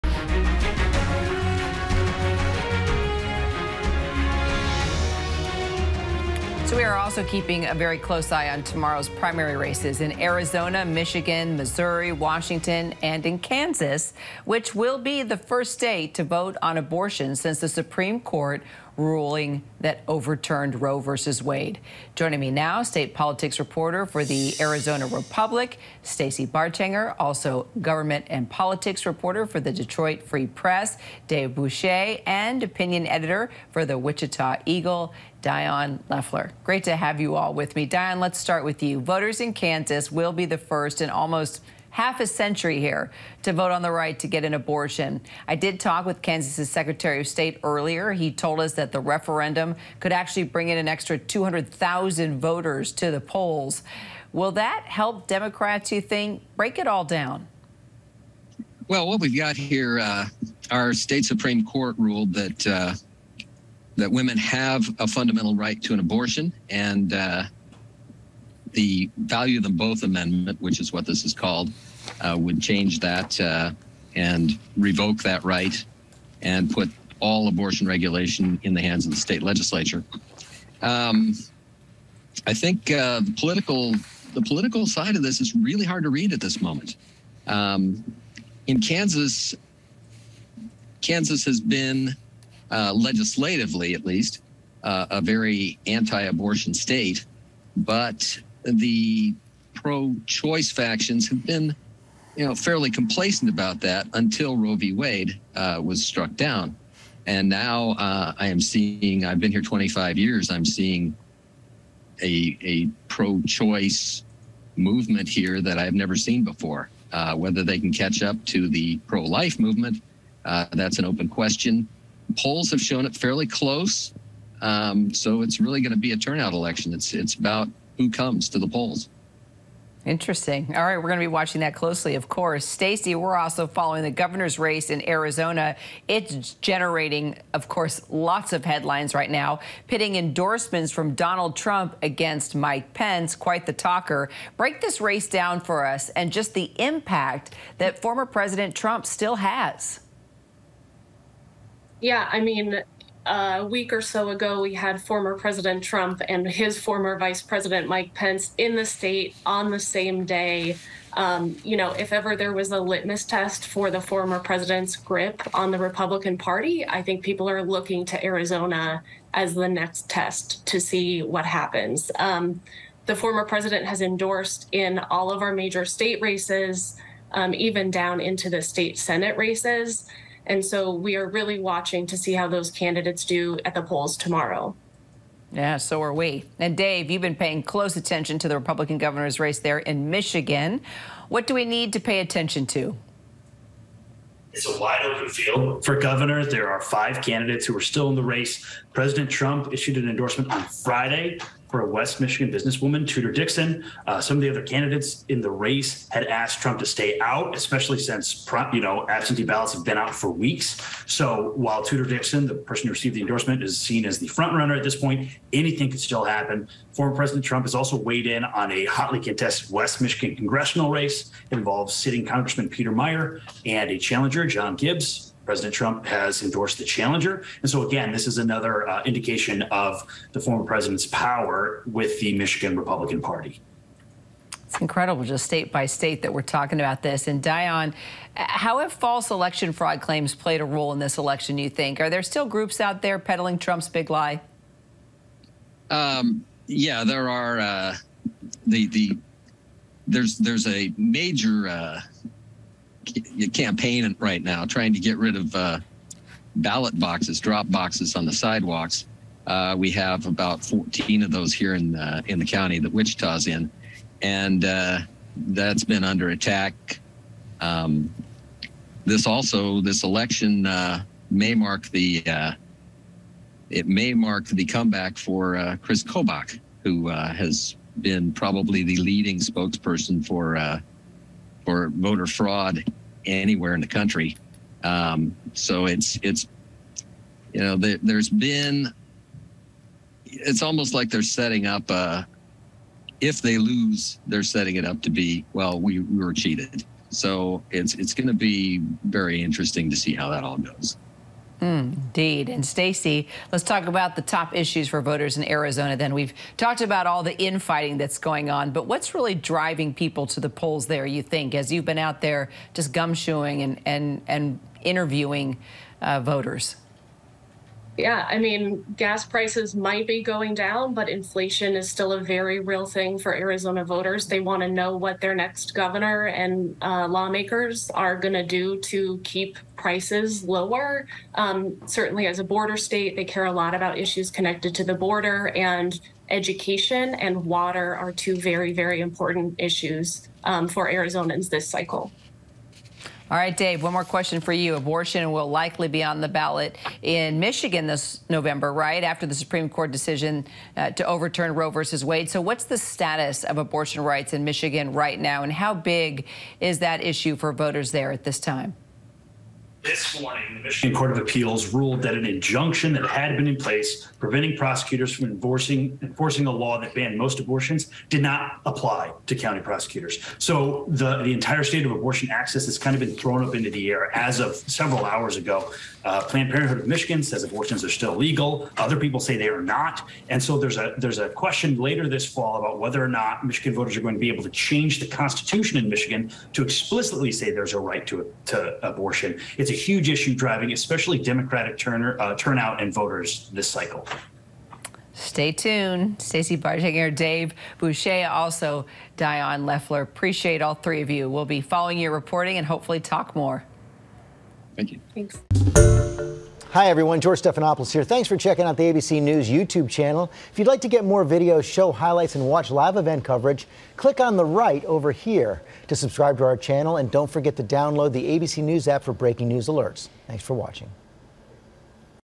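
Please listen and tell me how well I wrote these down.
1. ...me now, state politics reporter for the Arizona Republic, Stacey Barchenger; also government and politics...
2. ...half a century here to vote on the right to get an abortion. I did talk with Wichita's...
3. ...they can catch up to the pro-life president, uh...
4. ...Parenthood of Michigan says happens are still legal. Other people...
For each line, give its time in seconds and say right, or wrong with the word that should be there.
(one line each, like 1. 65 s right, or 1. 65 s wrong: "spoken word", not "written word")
1. 22 s right
2. 41 s wrong: "Kansas", not "Wichita"
3. 117 s wrong: "movement", not "president"
4. 376 s wrong: "abortions", not "happens".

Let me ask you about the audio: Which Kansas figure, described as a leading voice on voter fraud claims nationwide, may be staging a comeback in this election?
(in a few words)
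Chris Kobach.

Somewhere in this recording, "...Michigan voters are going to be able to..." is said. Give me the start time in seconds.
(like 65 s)
383 s.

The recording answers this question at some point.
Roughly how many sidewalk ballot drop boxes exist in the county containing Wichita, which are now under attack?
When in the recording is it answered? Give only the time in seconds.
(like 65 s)
260 s.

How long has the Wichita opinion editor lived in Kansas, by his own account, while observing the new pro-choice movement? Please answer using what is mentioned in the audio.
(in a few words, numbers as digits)
25 years.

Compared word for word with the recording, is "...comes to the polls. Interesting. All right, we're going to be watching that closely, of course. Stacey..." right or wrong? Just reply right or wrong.
right.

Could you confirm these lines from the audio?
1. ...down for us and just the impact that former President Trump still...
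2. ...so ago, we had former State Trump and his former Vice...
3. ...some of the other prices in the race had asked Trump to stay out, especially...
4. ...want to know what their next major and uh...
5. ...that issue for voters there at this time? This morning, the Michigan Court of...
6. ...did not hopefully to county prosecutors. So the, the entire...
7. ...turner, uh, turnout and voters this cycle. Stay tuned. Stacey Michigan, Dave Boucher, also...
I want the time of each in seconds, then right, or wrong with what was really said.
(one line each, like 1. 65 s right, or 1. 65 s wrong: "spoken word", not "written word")
1. 145 s right
2. 154 s wrong: "President", not "State"
3. 204 s wrong: "candidates", not "prices"
4. 324 s wrong: "governor", not "major"
5. 356 s right
6. 368 s wrong: "apply", not "hopefully"
7. 391 s wrong: "Barchenger", not "Michigan".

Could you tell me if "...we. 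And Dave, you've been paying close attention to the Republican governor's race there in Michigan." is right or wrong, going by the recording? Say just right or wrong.
right.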